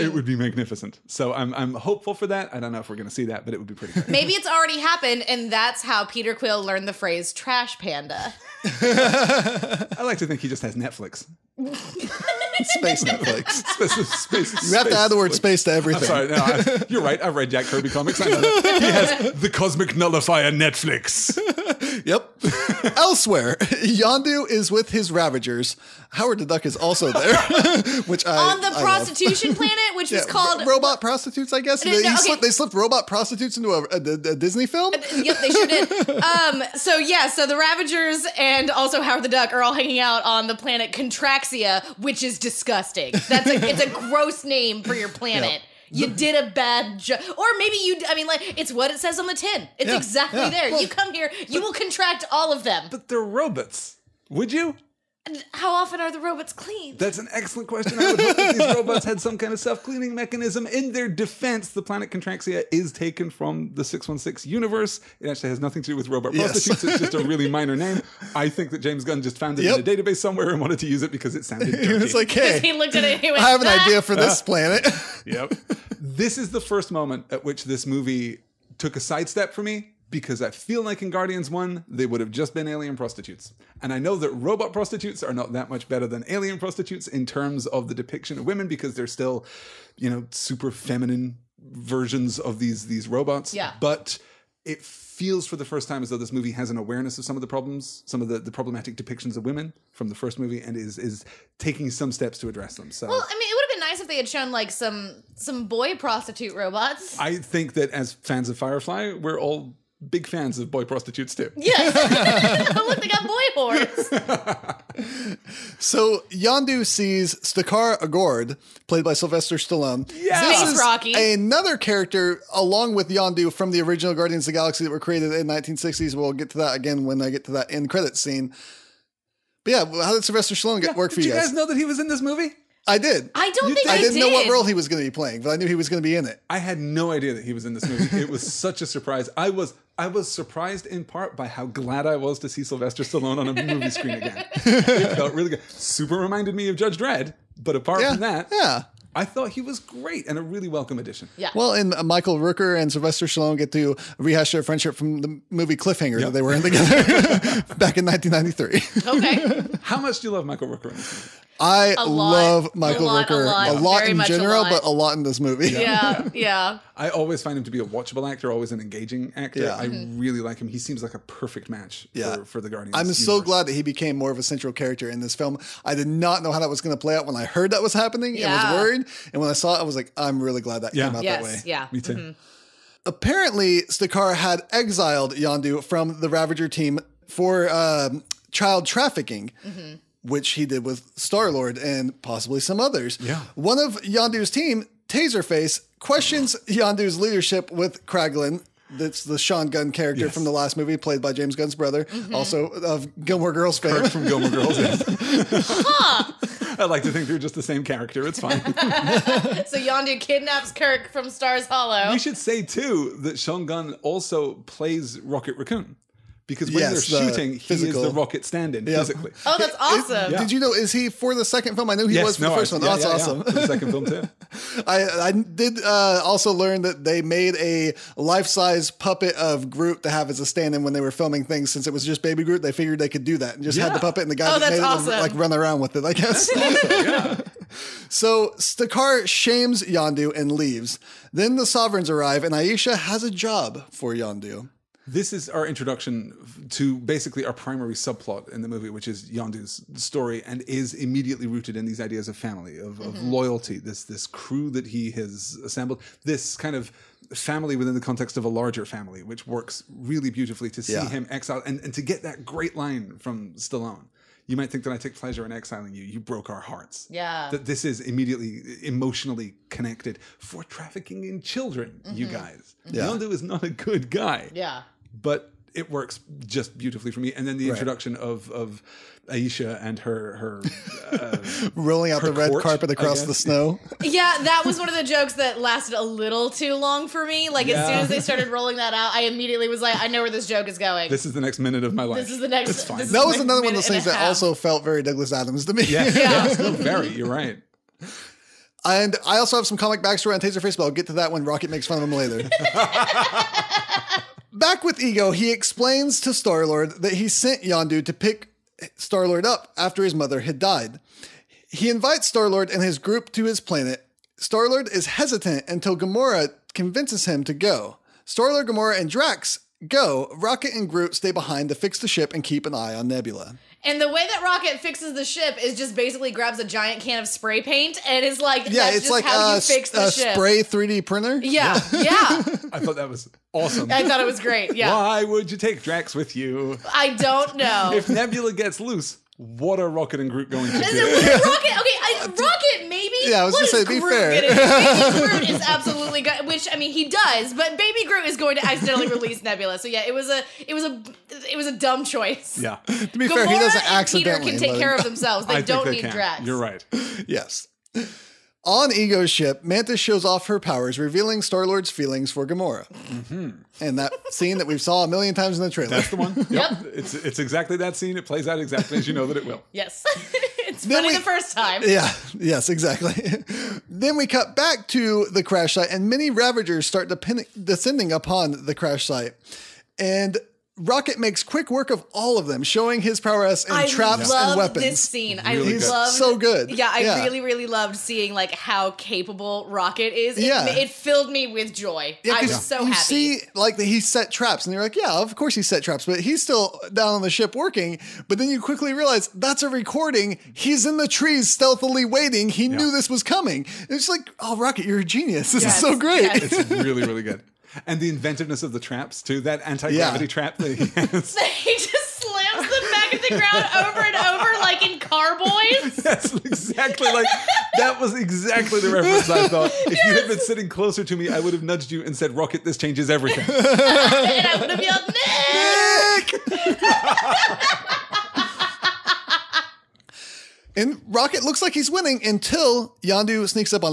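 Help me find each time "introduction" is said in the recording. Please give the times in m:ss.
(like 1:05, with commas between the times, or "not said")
4:05, 4:37.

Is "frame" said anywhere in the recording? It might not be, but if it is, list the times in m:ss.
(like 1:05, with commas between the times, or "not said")
not said.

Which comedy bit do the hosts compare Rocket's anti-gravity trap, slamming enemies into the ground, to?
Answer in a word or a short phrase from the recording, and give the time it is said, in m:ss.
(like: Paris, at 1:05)
Car Boys, at 6:54.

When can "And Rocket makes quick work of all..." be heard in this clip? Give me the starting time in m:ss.
6:19.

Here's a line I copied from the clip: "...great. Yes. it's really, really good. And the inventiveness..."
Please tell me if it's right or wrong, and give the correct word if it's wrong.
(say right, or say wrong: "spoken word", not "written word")
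right.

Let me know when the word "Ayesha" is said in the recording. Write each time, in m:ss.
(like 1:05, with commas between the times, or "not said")
4:02, 4:39.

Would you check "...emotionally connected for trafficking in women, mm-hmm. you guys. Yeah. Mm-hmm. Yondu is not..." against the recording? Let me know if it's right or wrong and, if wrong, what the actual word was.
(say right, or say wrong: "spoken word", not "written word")
wrong: "children", not "women".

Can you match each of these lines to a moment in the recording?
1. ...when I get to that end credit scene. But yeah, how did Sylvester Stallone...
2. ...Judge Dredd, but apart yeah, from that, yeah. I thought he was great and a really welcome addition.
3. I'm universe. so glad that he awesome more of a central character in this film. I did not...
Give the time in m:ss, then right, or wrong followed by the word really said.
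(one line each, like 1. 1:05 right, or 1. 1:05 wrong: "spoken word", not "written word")
1. 2:07 right
2. 2:26 right
3. 2:52 wrong: "became", not "awesome".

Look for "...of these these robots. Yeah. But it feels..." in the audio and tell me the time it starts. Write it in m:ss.
1:32.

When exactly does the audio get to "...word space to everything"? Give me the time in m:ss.
0:15.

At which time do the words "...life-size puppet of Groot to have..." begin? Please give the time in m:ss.
3:48.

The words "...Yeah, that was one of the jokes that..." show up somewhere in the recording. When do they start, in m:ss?
4:44.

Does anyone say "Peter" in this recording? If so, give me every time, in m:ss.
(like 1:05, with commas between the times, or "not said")
0:06, 5:54.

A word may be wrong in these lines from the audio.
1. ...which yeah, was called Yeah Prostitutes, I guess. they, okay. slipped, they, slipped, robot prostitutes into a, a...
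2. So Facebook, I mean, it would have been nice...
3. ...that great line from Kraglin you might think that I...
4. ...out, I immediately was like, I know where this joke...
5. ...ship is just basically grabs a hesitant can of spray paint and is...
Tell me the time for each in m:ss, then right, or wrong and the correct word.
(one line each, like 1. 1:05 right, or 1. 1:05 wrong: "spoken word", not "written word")
1. 0:29 wrong: "Robot", not "Yeah"
2. 1:42 wrong: "Well", not "Facebook"
3. 4:22 wrong: "Stallone", not "Kraglin"
4. 4:48 right
5. 5:25 wrong: "giant", not "hesitant".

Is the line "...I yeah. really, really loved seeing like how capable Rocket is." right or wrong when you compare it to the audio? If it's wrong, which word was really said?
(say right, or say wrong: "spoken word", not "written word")
right.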